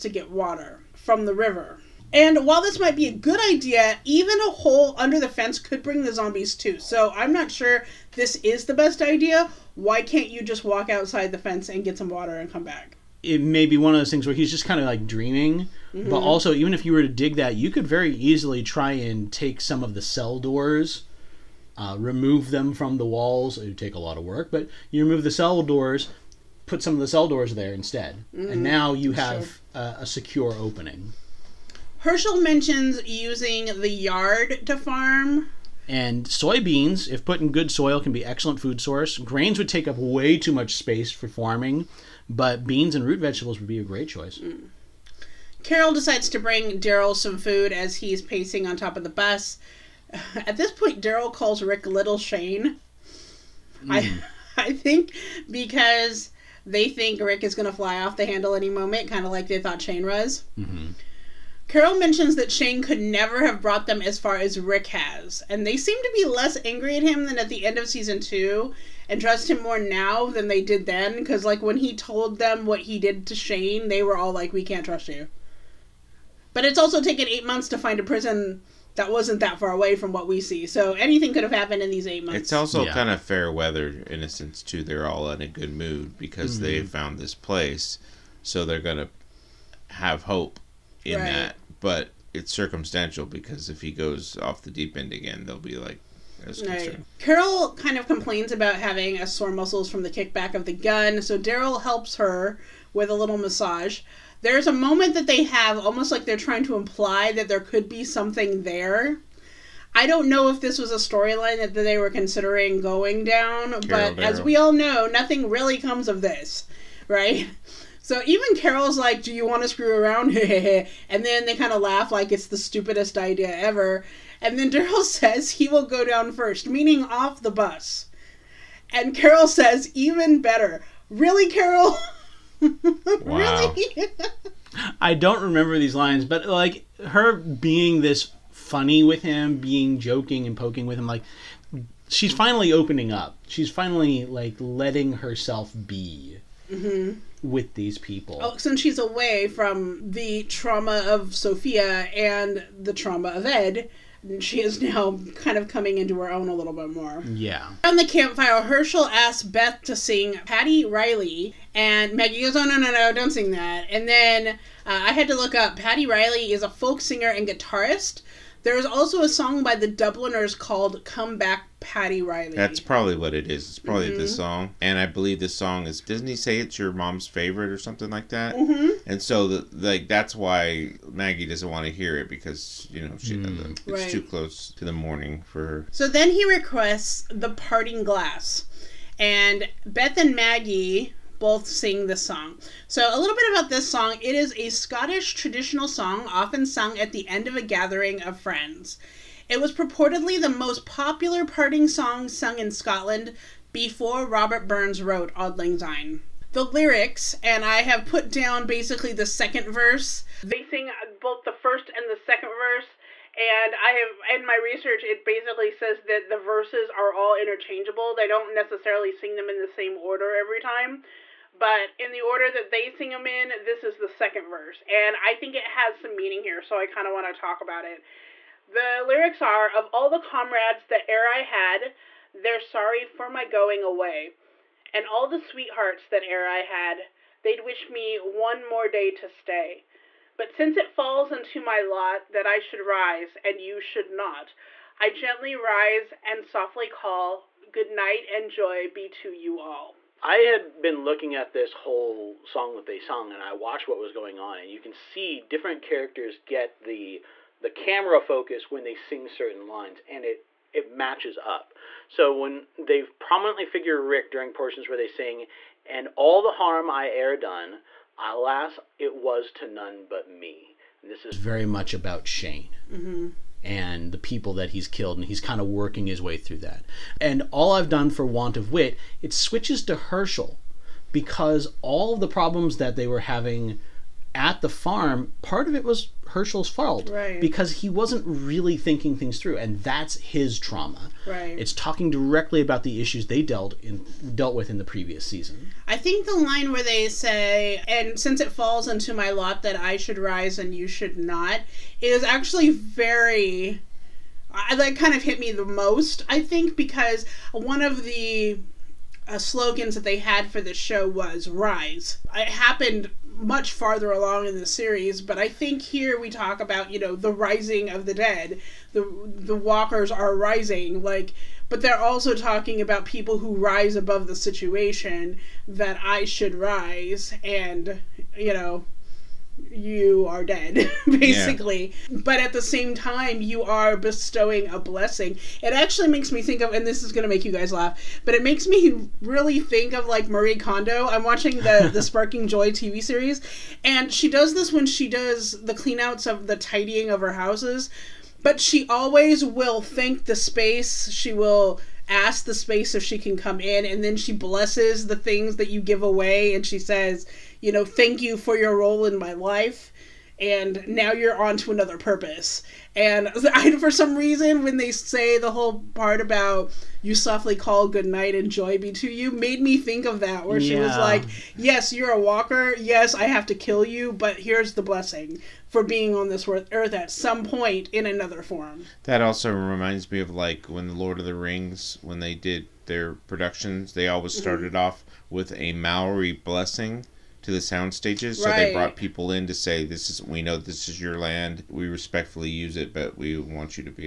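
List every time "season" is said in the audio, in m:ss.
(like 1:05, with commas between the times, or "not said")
1:07, 4:55.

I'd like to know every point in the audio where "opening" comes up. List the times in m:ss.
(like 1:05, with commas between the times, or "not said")
0:30, 2:22.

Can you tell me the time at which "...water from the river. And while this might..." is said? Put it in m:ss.
0:00.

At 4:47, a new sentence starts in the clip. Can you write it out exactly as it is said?
because he wasn't really thinking things through, and that's his trauma.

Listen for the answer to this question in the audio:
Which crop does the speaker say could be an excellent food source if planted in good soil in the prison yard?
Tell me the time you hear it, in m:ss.
0:36.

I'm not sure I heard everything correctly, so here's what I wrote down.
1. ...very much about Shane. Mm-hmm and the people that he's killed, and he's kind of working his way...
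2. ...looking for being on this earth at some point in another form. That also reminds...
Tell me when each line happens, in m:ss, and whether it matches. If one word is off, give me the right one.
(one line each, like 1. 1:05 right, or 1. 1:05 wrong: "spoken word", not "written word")
1. 4:31 right
2. 6:14 wrong: "blessing", not "looking".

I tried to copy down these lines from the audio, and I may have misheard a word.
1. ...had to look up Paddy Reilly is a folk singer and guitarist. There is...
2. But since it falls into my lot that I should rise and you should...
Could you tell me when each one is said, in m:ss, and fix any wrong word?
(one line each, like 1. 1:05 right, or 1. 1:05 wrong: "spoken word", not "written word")
1. 2:45 right
2. 4:00 right.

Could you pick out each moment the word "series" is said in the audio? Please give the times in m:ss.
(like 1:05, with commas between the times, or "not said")
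5:14, 5:43.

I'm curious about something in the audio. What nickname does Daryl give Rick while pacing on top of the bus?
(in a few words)
Little Shane.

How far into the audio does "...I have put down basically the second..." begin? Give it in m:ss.
3:27.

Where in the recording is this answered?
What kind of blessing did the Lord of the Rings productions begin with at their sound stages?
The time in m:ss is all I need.
6:25.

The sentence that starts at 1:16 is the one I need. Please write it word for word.
But it's also taken eight months to find a prison that wasn't that far away from what we see.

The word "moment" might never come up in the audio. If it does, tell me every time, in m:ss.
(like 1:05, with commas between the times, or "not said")
0:58, 1:44.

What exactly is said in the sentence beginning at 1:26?
they found this place, so they're gonna have hope in right.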